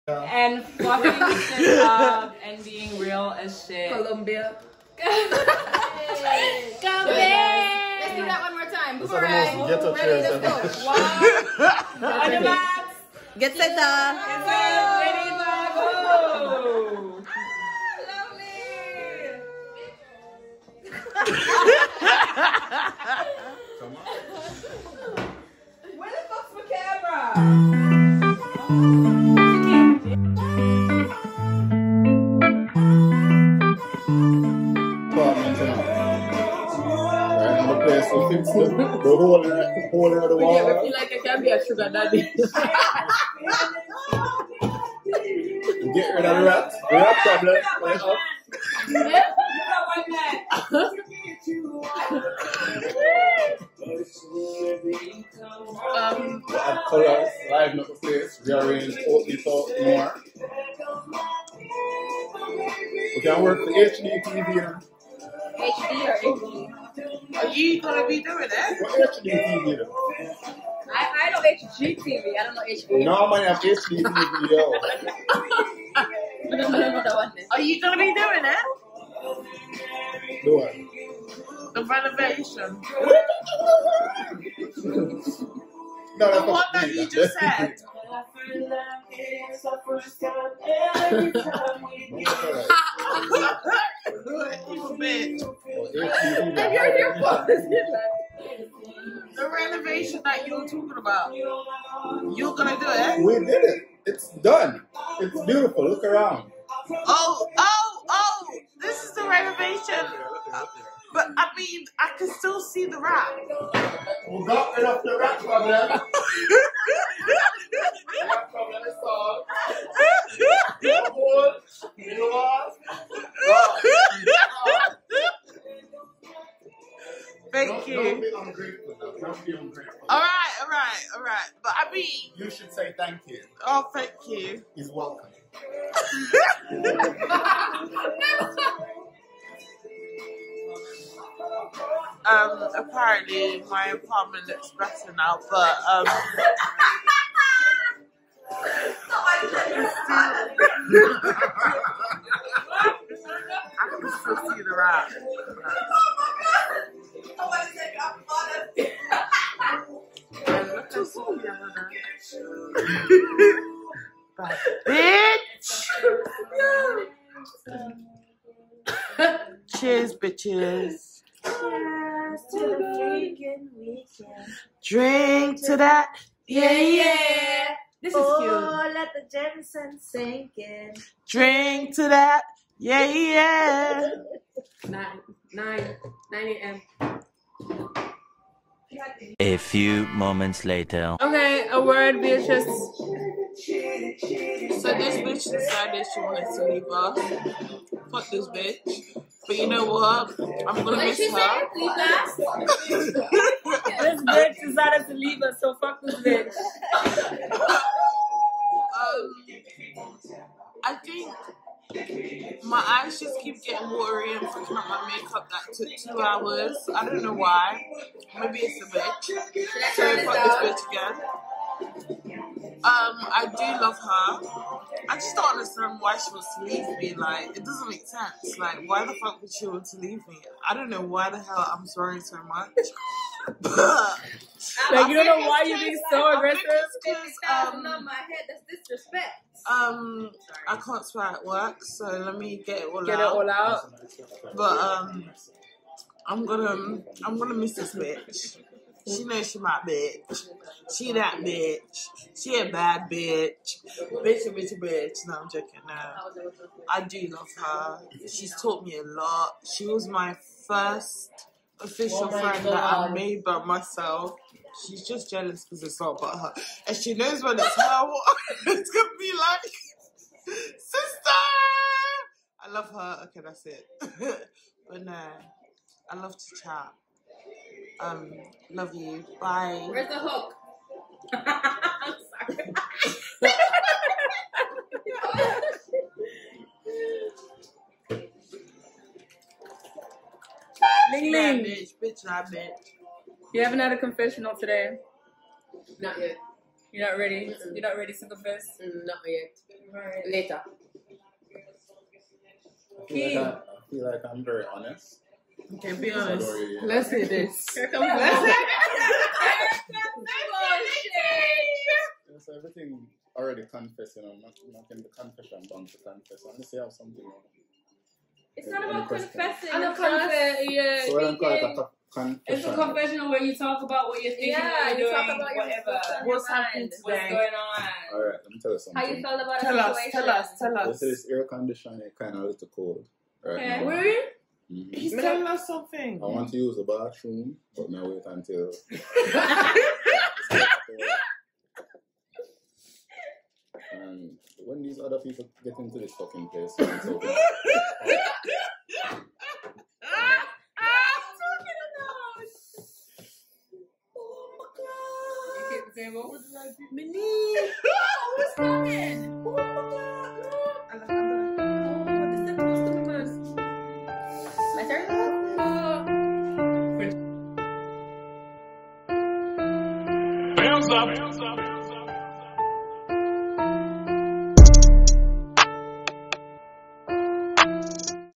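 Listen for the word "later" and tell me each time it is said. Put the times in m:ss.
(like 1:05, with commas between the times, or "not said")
3:10, 5:00.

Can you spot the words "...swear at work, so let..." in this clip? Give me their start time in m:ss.
4:01.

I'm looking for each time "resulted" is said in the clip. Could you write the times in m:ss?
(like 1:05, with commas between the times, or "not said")
not said.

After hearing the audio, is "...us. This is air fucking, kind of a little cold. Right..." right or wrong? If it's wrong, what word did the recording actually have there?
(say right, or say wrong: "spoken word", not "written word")
wrong: "conditioning", not "fucking".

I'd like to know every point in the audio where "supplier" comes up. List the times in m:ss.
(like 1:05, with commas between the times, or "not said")
not said.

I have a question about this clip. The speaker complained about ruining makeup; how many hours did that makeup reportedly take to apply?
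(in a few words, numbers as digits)
2 hours.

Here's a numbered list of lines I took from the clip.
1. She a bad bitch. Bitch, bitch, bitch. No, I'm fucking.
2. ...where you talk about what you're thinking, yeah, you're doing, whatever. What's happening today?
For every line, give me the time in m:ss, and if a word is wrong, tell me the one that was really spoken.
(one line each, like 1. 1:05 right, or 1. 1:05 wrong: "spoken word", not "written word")
1. 4:12 wrong: "joking", not "fucking"
2. 5:23 right.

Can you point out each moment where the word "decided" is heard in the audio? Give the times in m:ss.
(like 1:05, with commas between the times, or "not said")
3:15, 3:24.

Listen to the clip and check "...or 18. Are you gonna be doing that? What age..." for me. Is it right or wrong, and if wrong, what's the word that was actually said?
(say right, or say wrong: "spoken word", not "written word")
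right.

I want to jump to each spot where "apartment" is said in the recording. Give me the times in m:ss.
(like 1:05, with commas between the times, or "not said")
2:23.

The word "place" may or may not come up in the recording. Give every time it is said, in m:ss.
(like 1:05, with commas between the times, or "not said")
0:58, 5:46.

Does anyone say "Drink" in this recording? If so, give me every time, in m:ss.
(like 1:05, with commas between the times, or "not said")
2:54, 3:01.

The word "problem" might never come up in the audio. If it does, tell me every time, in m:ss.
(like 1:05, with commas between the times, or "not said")
0:47, 1:55.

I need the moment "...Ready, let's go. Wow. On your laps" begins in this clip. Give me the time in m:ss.
0:09.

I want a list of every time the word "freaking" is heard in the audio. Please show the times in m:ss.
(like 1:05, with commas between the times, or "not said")
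2:52.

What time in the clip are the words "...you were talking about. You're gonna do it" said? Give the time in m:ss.
1:40.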